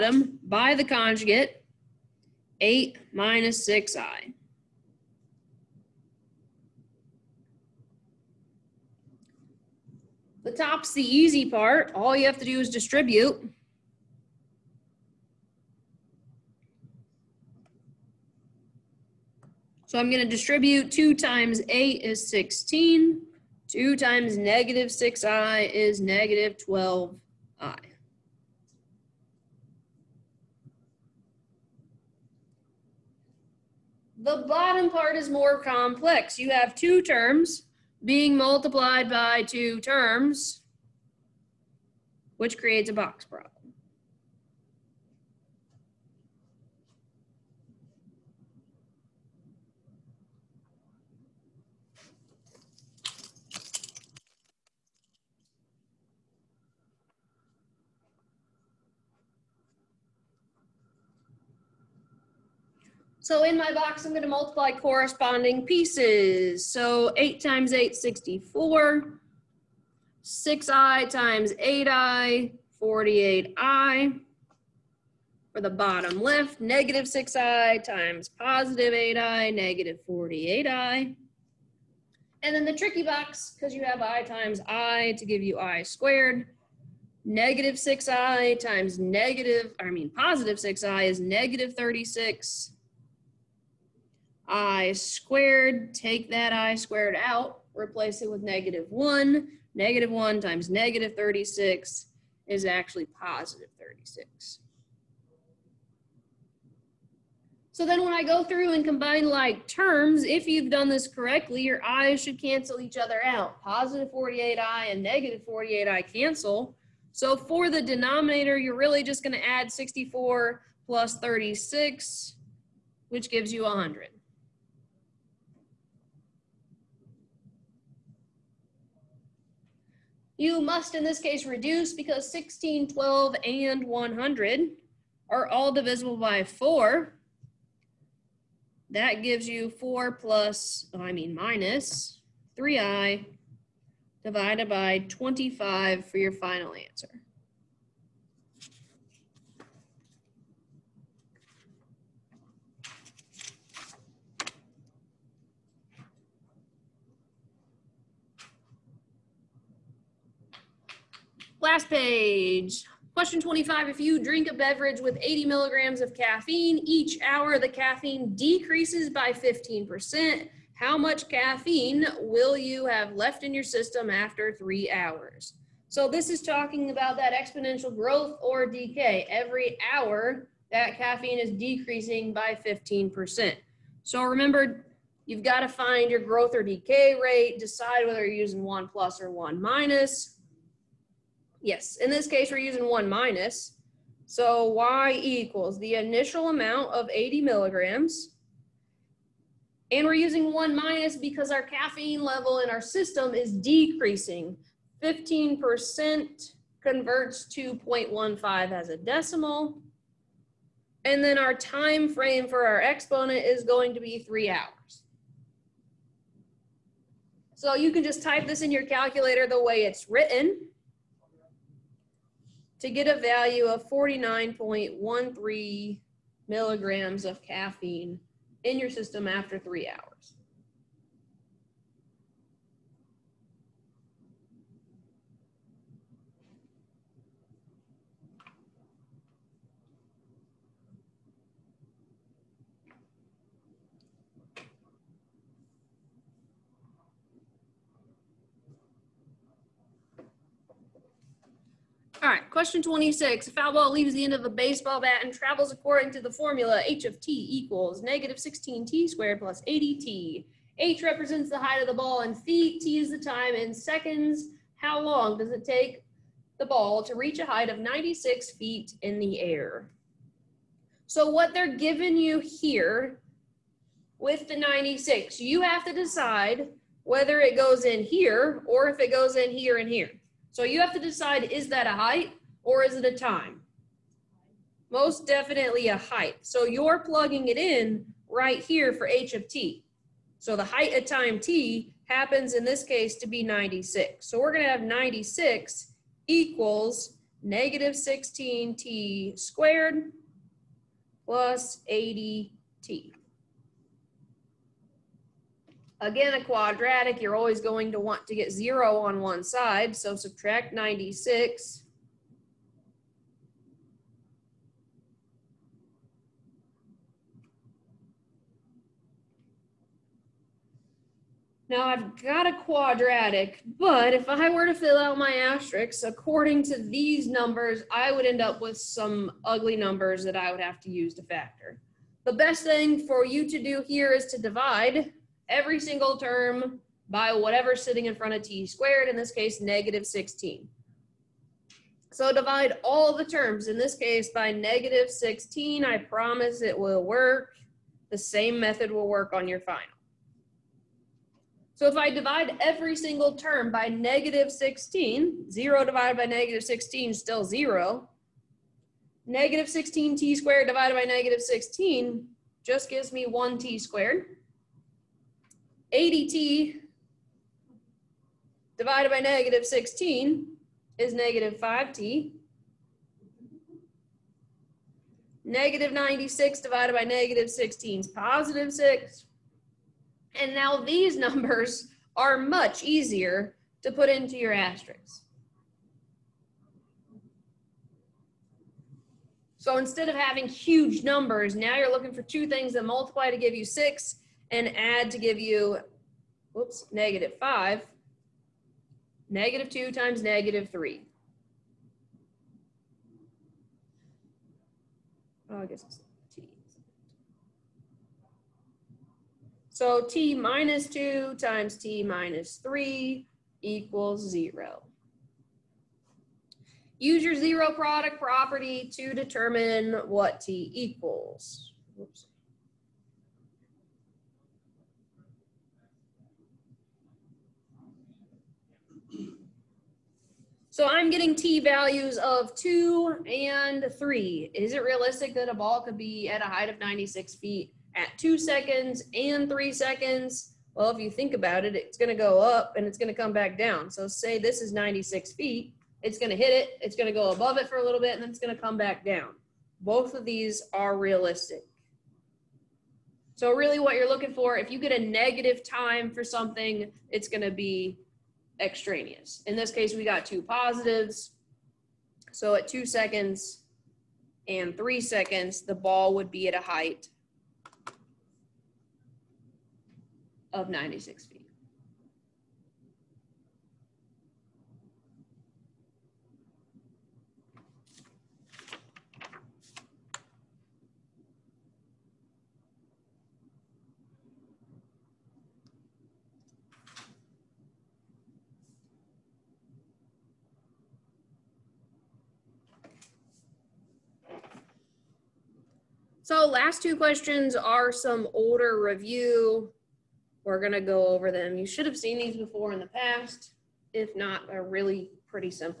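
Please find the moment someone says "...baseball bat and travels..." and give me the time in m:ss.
4:14.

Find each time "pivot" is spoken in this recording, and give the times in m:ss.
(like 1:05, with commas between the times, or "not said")
not said.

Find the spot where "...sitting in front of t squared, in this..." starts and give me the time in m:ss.
5:37.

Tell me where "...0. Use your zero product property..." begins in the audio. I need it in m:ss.
6:54.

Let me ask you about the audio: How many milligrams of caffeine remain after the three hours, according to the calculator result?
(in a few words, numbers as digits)
49.13 milligrams.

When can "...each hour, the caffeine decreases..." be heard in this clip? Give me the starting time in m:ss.
2:46.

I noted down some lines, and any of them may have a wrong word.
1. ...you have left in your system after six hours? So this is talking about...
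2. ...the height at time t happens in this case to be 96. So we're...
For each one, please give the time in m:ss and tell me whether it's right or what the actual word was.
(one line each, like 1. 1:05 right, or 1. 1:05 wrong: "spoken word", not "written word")
1. 2:52 wrong: "three", not "six"
2. 4:50 right.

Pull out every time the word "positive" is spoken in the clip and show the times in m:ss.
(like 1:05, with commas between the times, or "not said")
1:18, 1:30, 1:43, 1:53, 6:18, 7:40.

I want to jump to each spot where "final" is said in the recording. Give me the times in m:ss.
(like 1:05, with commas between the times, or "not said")
2:26, 5:49.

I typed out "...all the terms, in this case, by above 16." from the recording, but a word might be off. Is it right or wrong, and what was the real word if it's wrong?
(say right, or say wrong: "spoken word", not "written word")
wrong: "negative", not "above".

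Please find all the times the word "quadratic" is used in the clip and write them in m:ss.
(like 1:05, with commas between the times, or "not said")
5:06, 5:22.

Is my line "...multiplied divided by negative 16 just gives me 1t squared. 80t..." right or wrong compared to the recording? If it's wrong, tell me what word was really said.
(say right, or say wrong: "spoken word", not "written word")
wrong: "squared", not "multiplied".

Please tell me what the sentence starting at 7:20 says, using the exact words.
Well, if you think about it, it's going to go up and it's going to come back down.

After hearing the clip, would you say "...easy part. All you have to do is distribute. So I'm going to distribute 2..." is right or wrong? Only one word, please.
right.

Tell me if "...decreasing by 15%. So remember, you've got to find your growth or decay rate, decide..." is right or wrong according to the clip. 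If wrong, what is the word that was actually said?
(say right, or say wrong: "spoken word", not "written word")
right.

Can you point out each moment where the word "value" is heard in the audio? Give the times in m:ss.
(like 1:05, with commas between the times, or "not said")
3:43, 7:11.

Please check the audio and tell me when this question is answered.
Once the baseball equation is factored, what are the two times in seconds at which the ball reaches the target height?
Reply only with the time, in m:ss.
7:12.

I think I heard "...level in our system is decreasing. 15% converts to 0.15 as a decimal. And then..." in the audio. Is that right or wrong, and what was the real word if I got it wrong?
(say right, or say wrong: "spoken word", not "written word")
right.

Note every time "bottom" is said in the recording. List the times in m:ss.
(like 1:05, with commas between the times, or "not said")
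0:34, 1:15.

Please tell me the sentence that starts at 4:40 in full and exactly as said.
So you have to decide, is that a height or is it a time?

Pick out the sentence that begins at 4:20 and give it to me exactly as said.
h represents the height of the ball and feet, t is the time in seconds.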